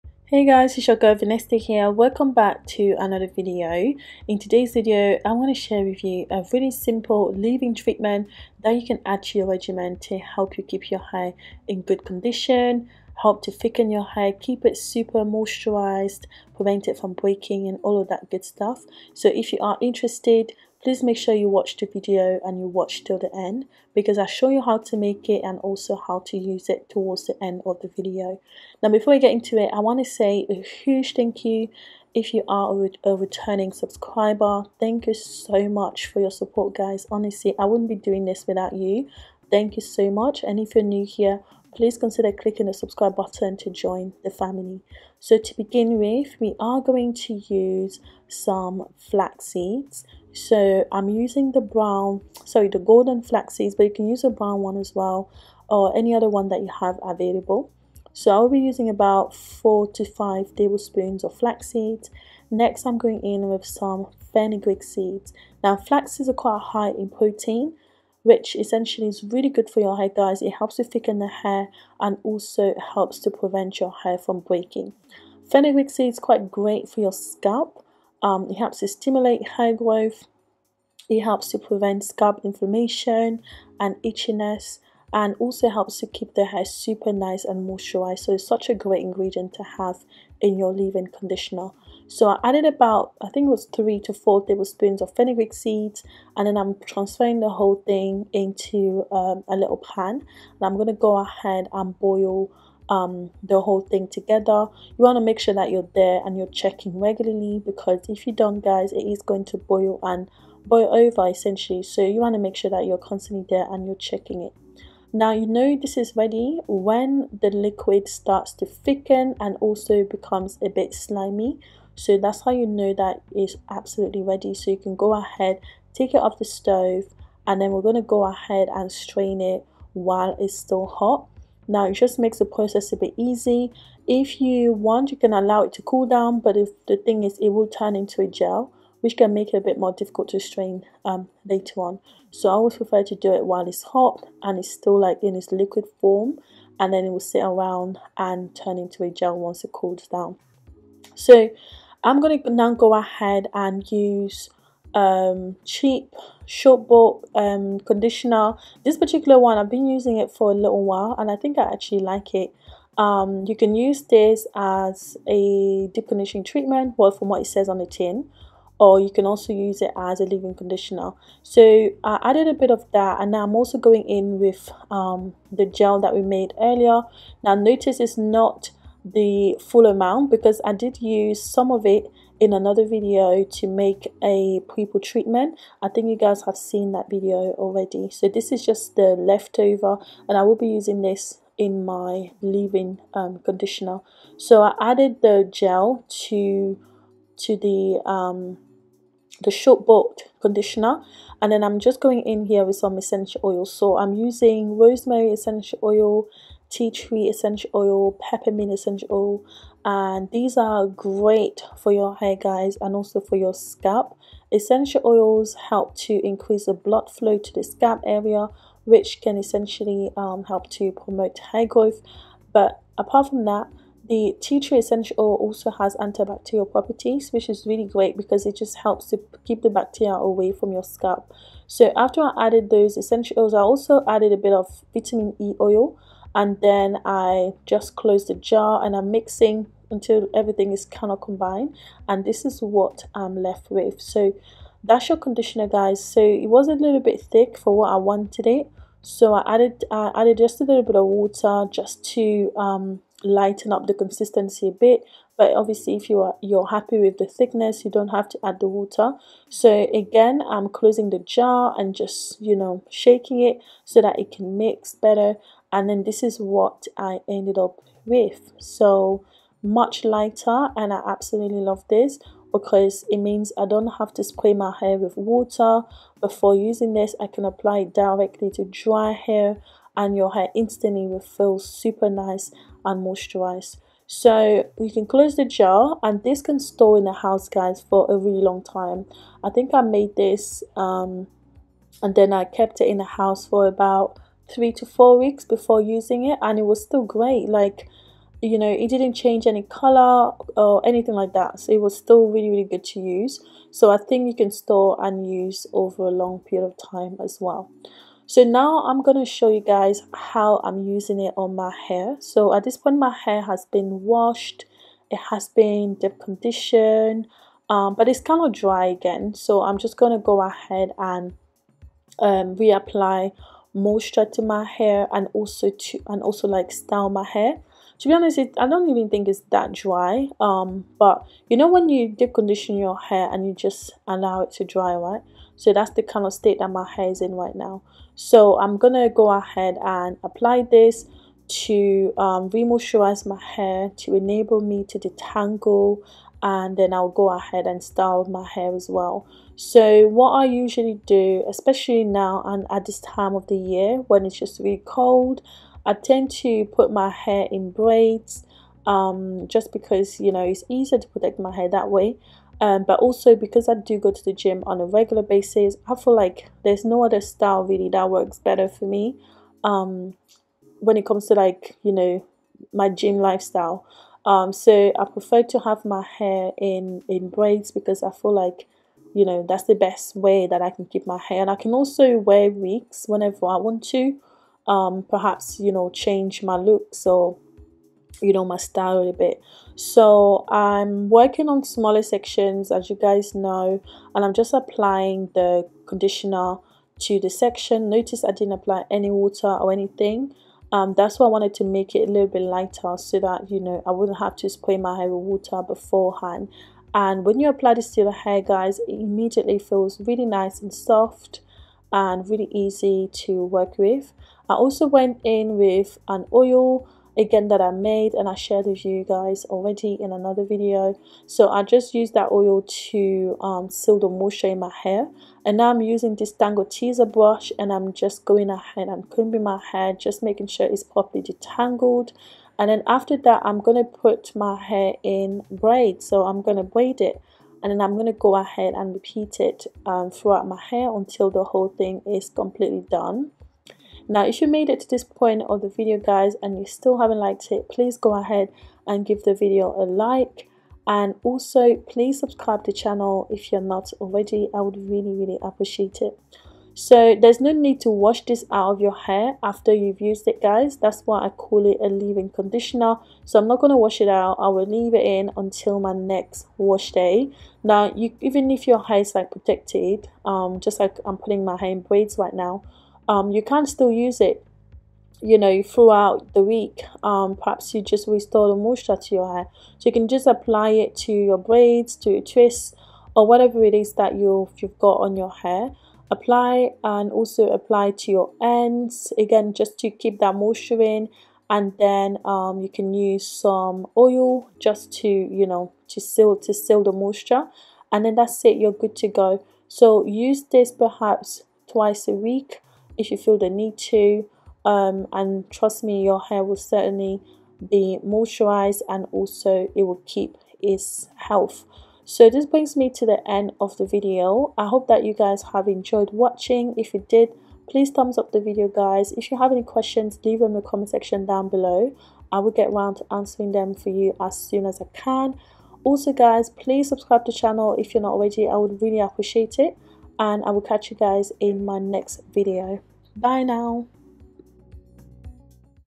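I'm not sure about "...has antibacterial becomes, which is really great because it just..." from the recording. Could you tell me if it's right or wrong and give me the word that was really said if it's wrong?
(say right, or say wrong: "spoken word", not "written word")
wrong: "properties", not "becomes".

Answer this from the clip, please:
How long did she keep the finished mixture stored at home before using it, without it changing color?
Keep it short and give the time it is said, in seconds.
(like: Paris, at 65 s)
3 to 4 weeks, at 294 s.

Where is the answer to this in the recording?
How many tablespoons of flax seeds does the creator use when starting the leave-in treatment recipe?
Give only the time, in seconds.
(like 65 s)
59 s.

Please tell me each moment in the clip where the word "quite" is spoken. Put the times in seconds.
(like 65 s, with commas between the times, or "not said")
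66 s, 76 s.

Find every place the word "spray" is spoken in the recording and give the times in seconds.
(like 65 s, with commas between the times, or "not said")
274 s, 404 s.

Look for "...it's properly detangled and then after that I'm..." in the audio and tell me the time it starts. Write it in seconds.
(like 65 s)
430 s.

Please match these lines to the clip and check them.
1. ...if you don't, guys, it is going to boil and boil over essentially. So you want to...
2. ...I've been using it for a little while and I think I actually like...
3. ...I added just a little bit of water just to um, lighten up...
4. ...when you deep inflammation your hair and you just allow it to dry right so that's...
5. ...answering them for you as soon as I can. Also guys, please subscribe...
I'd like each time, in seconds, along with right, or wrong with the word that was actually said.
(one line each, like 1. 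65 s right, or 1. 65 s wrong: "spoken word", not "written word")
1. 108 s right
2. 159 s right
3. 249 s right
4. 331 s wrong: "condition", not "inflammation"
5. 523 s right.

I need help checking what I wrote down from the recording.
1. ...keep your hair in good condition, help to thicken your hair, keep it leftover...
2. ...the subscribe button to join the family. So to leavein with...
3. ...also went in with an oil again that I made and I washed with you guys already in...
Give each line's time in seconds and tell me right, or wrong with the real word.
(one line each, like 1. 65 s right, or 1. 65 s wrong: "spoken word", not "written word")
1. 10 s wrong: "super", not "leftover"
2. 42 s wrong: "begin", not "leavein"
3. 414 s wrong: "shared", not "washed".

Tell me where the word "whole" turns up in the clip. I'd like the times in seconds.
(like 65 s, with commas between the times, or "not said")
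97 s, 103 s, 441 s.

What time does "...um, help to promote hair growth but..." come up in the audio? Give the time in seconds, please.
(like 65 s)
220 s.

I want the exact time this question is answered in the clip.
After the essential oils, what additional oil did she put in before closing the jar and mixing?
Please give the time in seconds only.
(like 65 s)
234 s.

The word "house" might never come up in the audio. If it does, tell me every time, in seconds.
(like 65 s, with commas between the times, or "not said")
287 s, 293 s.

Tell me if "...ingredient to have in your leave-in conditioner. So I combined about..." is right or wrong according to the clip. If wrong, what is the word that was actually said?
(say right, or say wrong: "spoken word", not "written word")
wrong: "added", not "combined".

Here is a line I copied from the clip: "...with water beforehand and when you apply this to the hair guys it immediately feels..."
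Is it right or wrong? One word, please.
right.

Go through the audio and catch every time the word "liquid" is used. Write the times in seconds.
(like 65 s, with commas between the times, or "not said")
117 s, 145 s.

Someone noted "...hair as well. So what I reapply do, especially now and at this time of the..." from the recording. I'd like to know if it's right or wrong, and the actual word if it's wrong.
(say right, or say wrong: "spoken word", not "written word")
wrong: "usually", not "reapply".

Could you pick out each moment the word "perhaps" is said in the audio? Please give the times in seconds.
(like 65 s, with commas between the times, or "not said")
385 s, 477 s, 500 s.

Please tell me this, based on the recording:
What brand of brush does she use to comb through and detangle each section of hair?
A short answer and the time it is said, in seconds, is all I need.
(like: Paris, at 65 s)
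Tangle Teezer, at 426 s.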